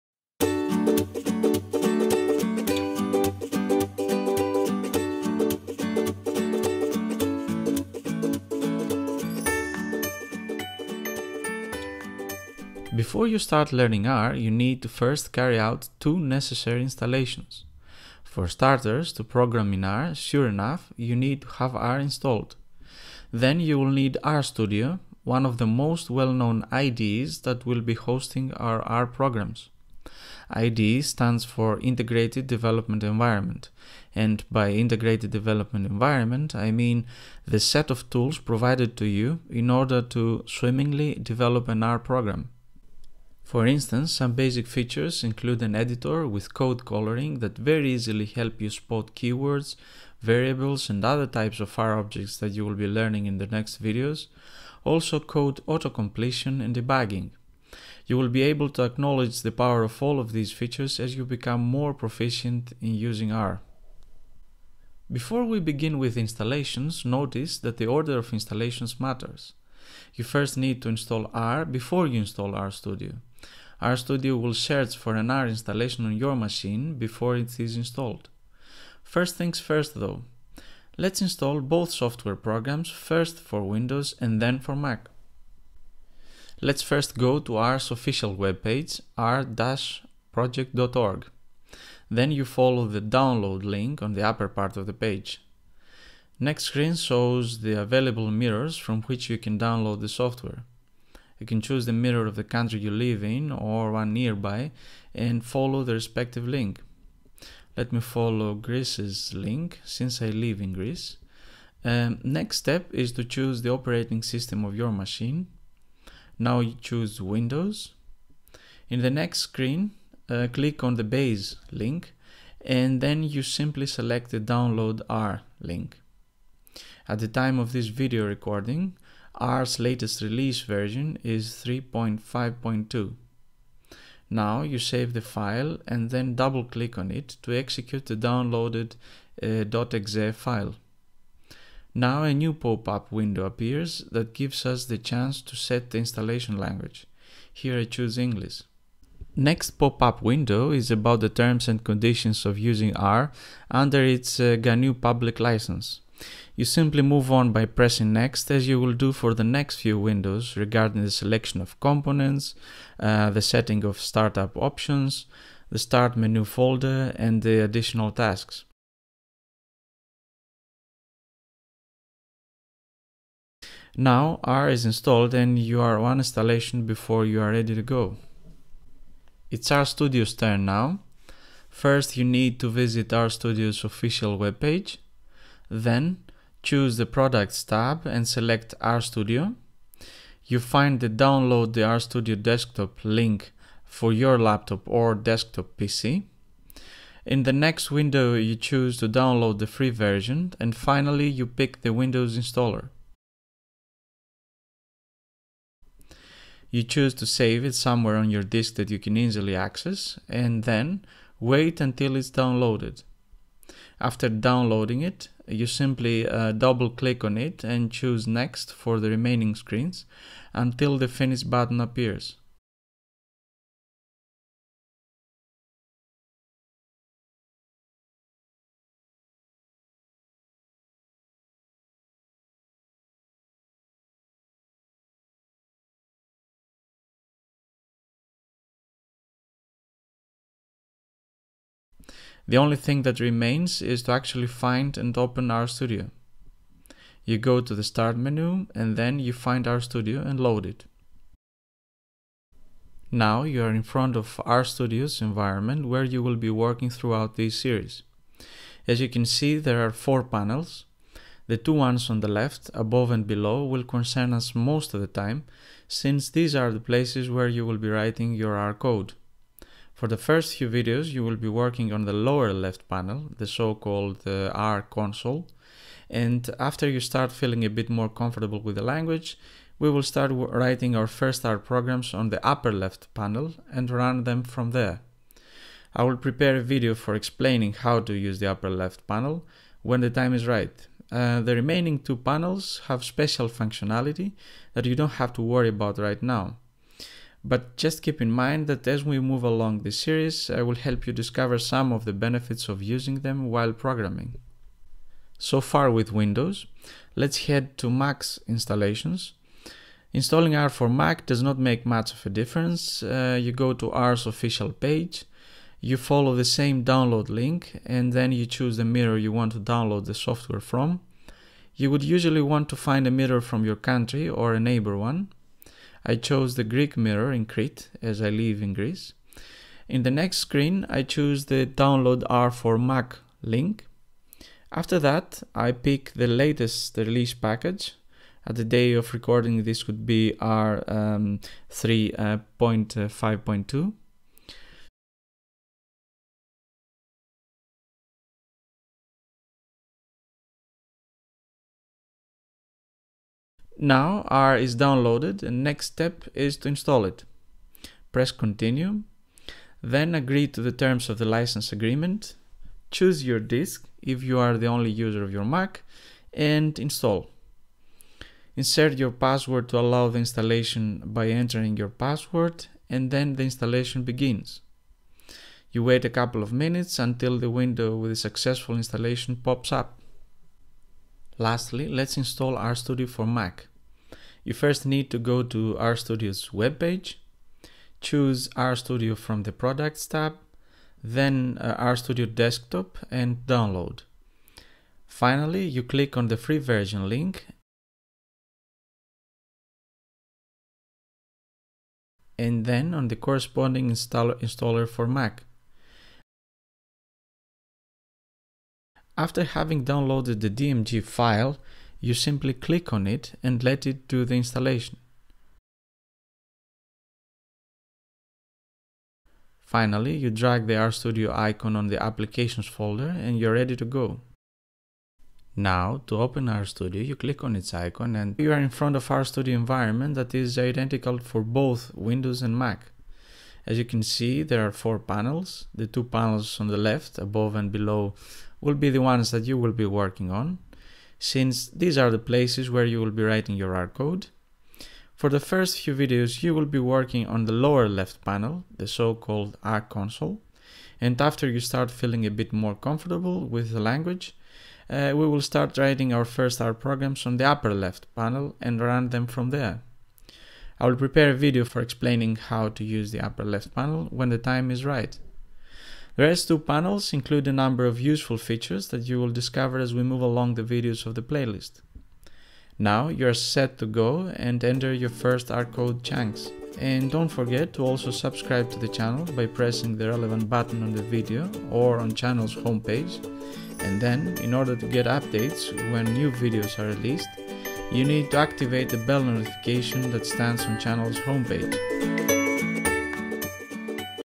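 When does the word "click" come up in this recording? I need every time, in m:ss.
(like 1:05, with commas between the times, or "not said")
2:00, 2:16, 3:36, 6:35, 6:52, 7:07.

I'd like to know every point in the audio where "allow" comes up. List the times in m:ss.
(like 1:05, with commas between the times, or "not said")
6:09.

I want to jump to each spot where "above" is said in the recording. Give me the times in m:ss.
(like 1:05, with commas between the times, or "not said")
4:22, 7:17.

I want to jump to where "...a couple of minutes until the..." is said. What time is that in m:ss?
6:16.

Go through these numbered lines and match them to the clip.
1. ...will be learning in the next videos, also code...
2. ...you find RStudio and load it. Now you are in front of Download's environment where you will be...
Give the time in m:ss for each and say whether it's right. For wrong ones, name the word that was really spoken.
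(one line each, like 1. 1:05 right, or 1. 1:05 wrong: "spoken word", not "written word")
1. 0:52 right
2. 4:09 wrong: "RStudio", not "Download".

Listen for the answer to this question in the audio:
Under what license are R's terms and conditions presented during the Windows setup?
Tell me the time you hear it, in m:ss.
2:34.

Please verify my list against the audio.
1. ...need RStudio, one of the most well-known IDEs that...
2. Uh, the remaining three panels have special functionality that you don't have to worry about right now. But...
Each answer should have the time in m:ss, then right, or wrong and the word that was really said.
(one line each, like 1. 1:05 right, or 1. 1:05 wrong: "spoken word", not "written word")
1. 0:24 right
2. 4:51 wrong: "two", not "three".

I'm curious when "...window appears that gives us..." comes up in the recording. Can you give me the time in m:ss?
2:23.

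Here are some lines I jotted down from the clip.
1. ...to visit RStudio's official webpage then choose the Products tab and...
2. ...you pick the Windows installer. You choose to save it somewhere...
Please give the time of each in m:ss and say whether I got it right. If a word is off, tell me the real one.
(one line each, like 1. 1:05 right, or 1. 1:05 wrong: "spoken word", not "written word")
1. 3:02 right
2. 3:21 right.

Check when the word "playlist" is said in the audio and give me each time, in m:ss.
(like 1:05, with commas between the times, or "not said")
7:51.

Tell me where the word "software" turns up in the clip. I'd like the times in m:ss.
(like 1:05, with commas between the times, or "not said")
1:21, 1:40, 5:20.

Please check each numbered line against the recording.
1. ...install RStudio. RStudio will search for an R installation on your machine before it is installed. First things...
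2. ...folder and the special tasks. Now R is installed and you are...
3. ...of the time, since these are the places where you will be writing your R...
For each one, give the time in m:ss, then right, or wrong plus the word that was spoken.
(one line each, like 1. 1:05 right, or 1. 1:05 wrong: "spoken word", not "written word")
1. 1:12 right
2. 2:46 wrong: "additional", not "special"
3. 4:24 right.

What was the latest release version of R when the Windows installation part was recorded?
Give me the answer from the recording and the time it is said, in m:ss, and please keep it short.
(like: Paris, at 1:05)
3.5.2, at 2:11.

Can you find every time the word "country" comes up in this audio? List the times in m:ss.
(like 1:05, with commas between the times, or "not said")
1:42, 5:23.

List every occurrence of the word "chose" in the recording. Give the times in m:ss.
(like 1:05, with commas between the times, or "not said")
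5:26.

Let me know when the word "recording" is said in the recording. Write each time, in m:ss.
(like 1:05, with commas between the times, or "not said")
2:08, 5:39.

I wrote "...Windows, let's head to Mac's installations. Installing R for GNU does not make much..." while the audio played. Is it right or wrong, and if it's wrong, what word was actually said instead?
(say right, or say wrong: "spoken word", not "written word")
wrong: "Mac", not "GNU".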